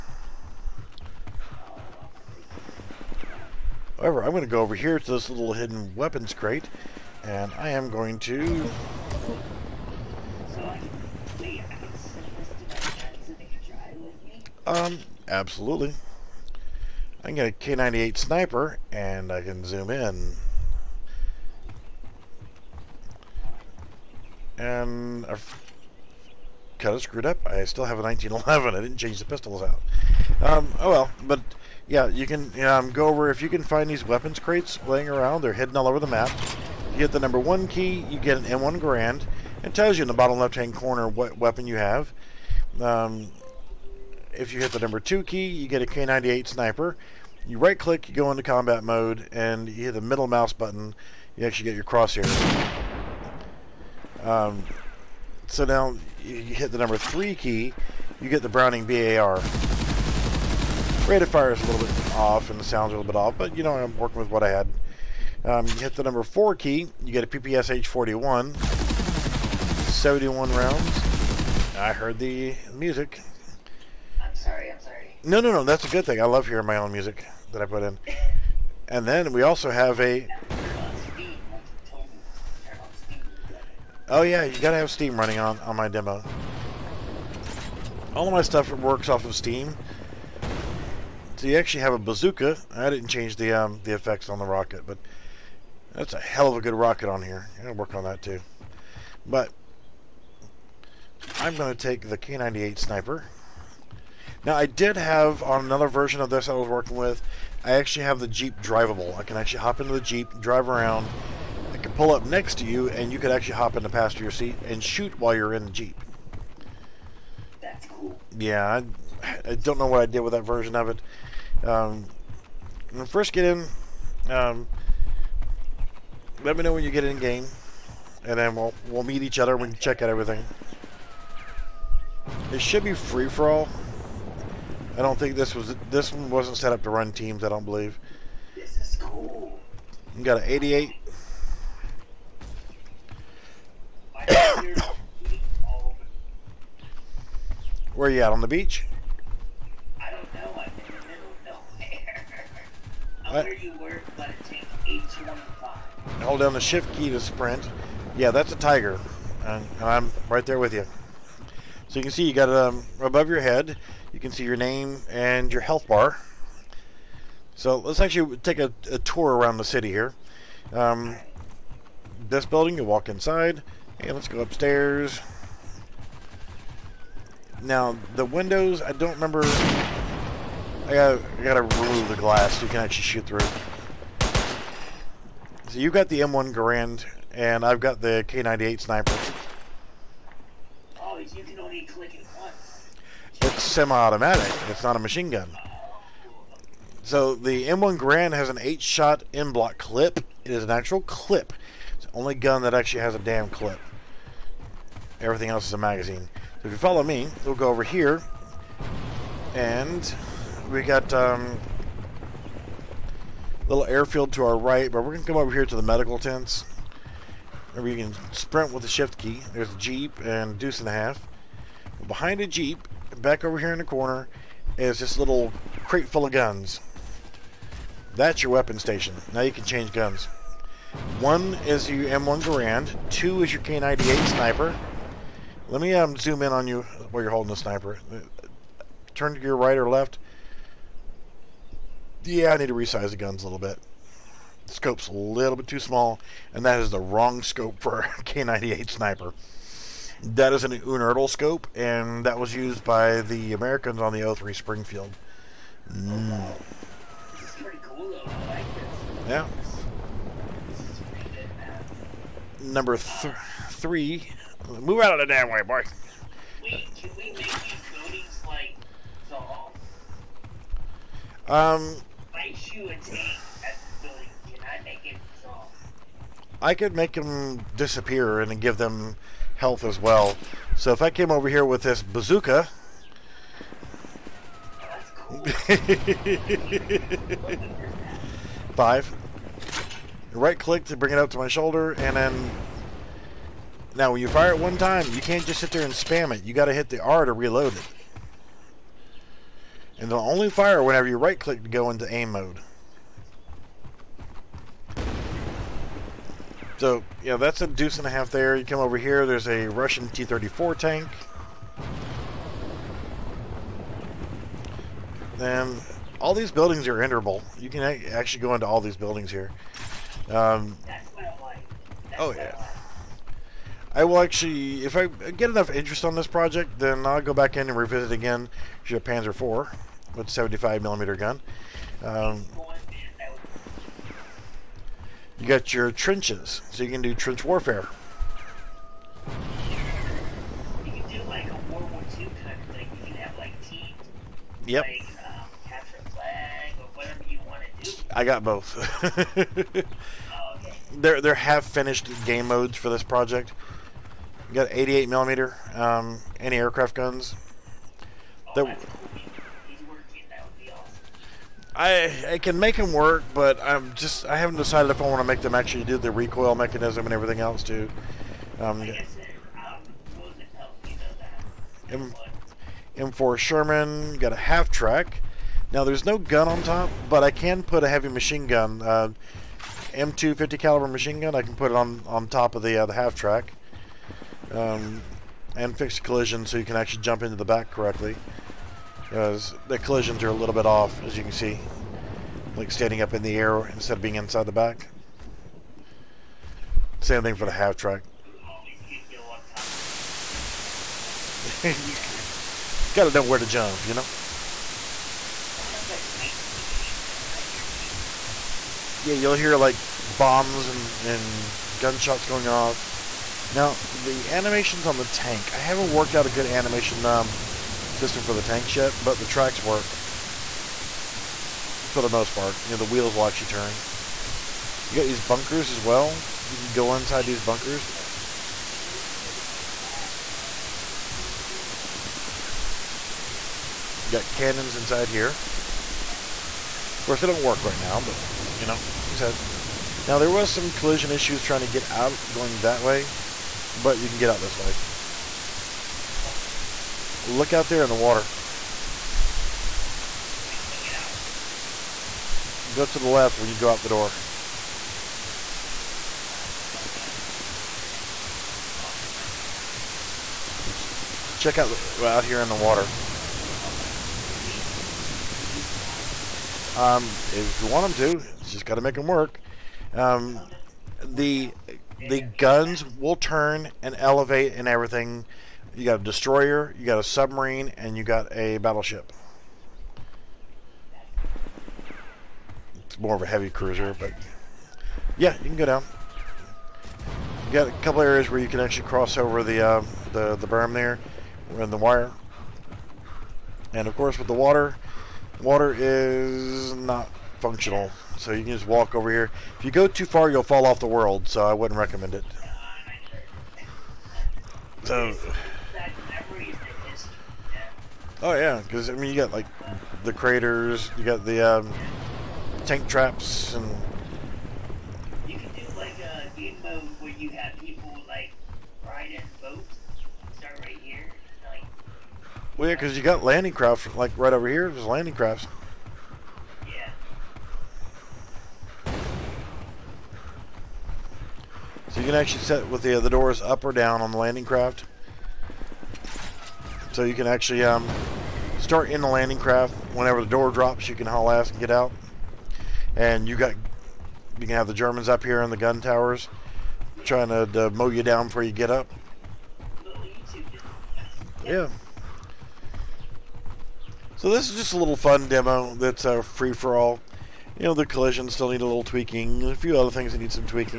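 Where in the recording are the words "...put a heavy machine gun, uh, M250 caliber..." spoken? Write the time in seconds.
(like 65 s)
377 s.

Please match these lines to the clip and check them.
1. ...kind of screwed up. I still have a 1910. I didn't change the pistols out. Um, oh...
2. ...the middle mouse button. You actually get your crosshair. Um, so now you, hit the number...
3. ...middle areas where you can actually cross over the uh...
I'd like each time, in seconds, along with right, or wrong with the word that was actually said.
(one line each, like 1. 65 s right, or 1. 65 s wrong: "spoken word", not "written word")
1. 26 s wrong: "1911", not "1910"
2. 49 s right
3. 487 s wrong: "couple", not "middle".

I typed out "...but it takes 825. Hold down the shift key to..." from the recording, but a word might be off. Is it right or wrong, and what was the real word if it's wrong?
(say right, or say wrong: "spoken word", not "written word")
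right.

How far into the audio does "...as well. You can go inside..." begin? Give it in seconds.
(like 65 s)
425 s.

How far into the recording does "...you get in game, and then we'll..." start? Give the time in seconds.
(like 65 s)
126 s.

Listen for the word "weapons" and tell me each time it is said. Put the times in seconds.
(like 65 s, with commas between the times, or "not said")
5 s, 34 s, 41 s, 228 s.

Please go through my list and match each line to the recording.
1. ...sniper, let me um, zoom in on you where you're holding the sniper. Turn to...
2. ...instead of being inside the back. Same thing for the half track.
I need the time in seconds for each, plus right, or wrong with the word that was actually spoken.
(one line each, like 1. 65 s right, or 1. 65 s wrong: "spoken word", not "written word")
1. 234 s right
2. 393 s right.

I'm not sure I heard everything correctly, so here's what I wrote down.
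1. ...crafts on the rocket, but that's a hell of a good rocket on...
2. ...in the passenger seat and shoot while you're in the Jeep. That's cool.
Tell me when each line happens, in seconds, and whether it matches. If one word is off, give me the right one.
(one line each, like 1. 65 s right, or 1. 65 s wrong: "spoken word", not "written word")
1. 93 s wrong: "effects", not "crafts"
2. 113 s right.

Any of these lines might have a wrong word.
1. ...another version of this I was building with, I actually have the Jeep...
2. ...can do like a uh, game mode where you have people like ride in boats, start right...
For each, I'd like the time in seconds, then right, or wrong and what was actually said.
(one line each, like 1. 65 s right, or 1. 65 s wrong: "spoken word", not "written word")
1. 105 s wrong: "working", not "building"
2. 515 s right.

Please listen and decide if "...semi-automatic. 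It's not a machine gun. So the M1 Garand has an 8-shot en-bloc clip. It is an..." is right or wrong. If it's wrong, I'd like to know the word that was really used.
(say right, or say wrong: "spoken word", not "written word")
right.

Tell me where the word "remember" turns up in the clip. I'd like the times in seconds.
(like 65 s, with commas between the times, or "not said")
179 s, 217 s.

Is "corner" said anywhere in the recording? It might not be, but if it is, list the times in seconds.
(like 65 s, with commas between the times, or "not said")
40 s, 223 s.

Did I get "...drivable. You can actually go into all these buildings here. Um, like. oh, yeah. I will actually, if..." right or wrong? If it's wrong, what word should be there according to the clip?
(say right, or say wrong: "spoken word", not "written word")
wrong: "enterable", not "drivable".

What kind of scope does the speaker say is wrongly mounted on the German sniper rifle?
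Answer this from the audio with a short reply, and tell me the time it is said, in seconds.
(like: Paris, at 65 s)
Unertl scope, at 250 s.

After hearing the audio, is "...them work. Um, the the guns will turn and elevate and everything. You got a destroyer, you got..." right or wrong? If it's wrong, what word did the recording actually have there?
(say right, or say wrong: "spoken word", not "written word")
right.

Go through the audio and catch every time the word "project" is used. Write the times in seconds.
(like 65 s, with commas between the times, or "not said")
326 s, 353 s.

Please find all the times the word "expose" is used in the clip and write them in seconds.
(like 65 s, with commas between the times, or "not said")
not said.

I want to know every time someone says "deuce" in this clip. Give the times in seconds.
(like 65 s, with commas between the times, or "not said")
220 s, 307 s.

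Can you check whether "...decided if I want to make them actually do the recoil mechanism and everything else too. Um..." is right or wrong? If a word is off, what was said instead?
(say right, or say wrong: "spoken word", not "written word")
right.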